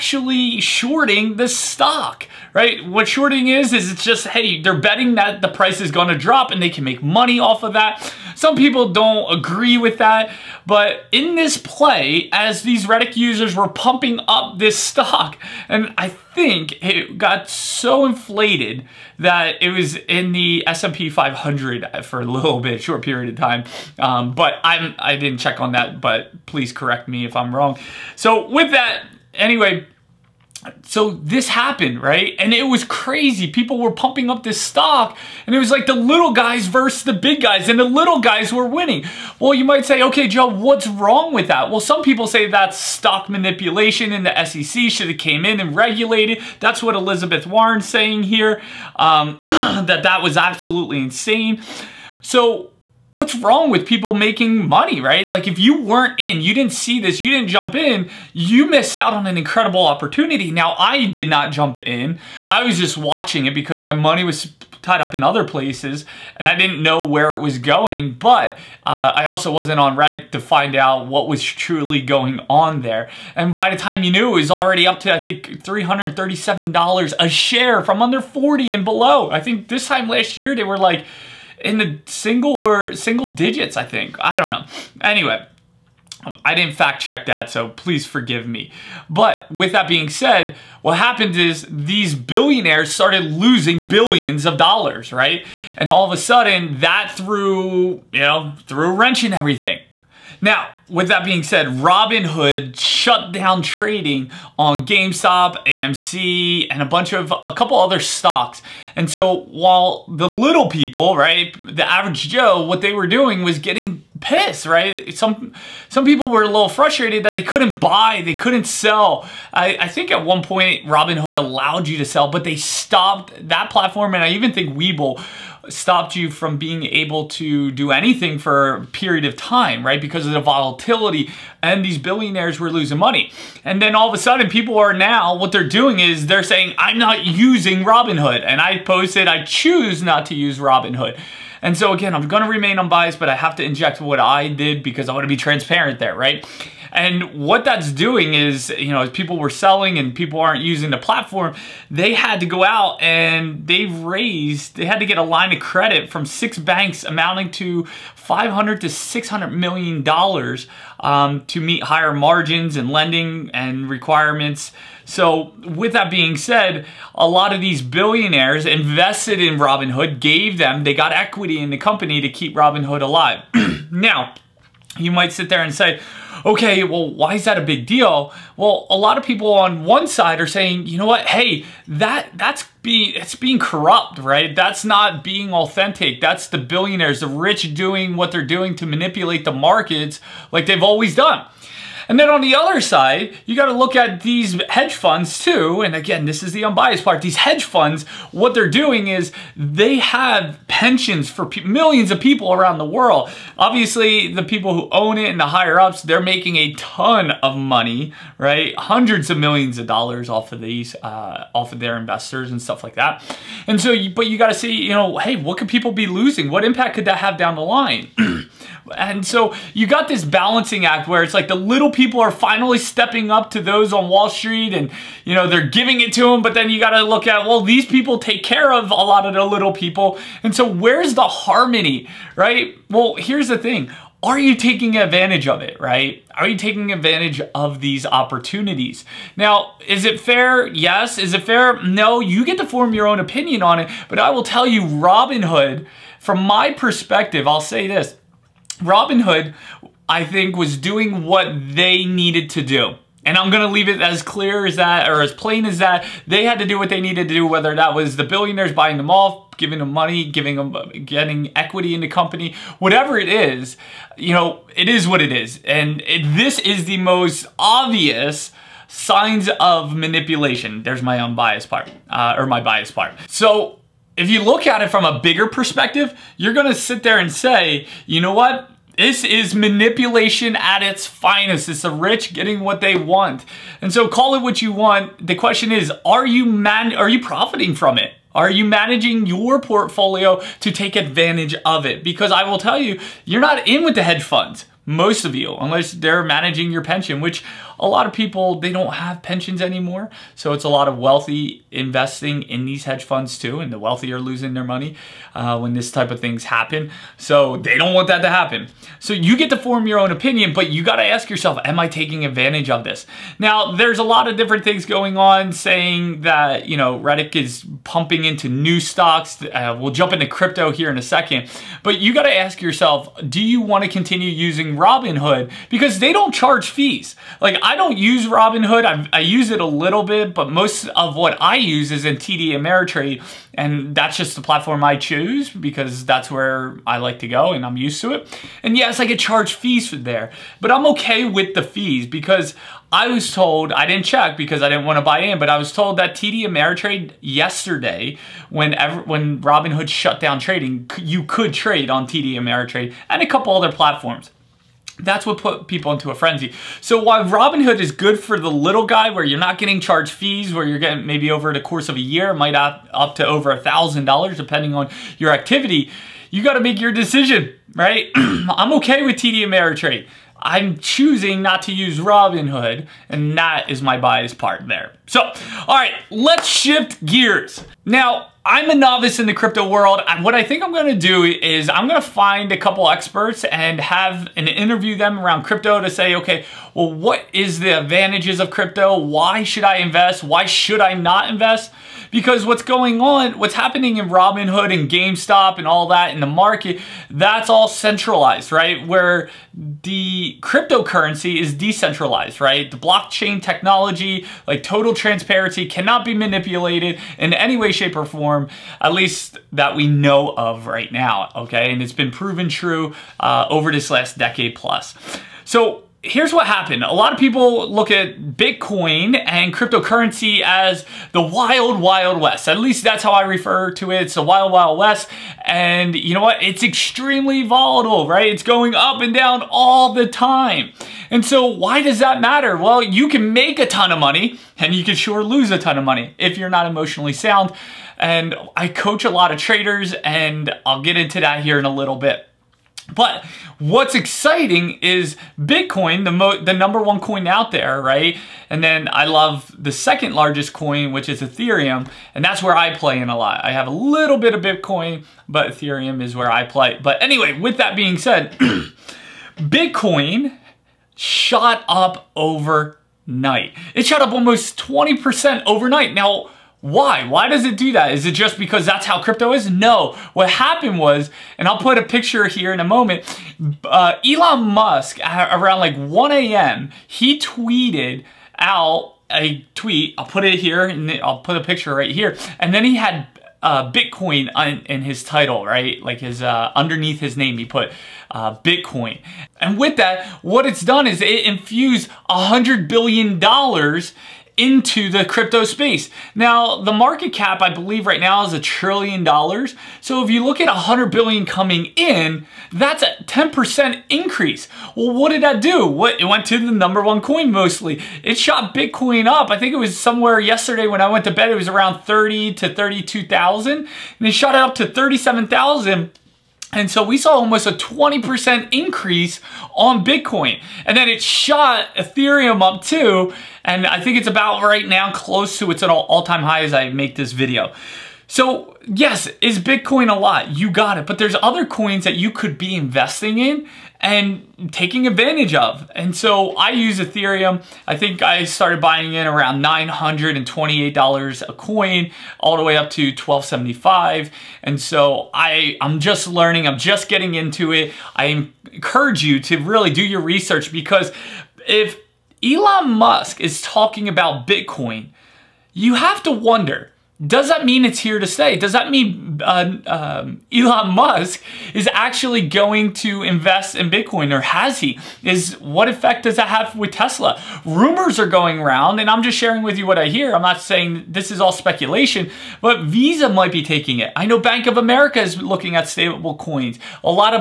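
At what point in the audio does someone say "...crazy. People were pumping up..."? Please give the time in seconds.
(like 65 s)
32 s.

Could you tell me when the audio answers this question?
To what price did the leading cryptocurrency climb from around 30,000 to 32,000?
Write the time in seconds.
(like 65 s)
514 s.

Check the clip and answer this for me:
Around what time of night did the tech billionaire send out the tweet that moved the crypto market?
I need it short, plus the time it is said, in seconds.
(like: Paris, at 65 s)
1 a.m., at 475 s.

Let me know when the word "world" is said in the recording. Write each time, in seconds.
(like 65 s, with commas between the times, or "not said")
202 s, 379 s.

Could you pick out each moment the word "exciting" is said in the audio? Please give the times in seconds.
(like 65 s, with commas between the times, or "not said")
443 s.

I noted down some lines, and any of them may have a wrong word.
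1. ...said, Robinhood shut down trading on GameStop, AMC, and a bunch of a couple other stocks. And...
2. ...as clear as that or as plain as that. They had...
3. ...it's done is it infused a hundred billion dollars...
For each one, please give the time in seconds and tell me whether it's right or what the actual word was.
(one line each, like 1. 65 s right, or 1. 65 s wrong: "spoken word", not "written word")
1. 101 s right
2. 254 s right
3. 490 s right.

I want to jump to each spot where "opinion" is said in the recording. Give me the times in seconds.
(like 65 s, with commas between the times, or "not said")
243 s, 310 s.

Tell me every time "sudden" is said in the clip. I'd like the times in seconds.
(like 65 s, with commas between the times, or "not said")
96 s, 134 s.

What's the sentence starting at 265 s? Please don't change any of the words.
And it, this is the most obvious signs of manipulation.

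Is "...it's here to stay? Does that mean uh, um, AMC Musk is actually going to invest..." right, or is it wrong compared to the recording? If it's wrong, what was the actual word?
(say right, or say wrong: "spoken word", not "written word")
wrong: "Elon", not "AMC".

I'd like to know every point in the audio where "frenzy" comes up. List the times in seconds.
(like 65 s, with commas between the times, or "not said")
356 s.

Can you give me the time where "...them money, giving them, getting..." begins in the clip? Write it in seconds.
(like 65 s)
259 s.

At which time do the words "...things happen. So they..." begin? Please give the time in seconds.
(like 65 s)
306 s.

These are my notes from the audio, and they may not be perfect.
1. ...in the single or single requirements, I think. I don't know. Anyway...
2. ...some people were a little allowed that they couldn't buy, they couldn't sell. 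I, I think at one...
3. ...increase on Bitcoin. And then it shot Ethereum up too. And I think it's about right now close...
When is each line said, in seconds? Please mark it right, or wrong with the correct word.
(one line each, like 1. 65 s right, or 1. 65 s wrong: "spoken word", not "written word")
1. 81 s wrong: "digits", not "requirements"
2. 115 s wrong: "frustrated", not "allowed"
3. 518 s right.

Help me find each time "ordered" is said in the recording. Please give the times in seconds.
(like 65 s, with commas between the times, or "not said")
not said.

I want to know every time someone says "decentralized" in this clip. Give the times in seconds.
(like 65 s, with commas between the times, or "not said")
401 s.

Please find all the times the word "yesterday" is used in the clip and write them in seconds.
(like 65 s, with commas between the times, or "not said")
347 s, 510 s.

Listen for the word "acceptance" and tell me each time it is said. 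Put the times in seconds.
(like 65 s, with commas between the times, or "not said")
not said.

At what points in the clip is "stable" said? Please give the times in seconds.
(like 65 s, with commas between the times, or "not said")
575 s.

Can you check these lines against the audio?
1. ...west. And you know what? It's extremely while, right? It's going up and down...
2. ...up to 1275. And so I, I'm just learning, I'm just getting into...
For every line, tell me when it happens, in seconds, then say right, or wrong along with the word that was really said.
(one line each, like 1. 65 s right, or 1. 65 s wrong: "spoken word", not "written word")
1. 424 s wrong: "volatile", not "while"
2. 542 s right.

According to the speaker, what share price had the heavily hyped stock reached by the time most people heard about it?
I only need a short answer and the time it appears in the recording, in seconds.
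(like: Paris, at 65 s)
$337, at 75 s.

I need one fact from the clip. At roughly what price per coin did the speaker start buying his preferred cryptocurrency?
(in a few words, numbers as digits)
$928.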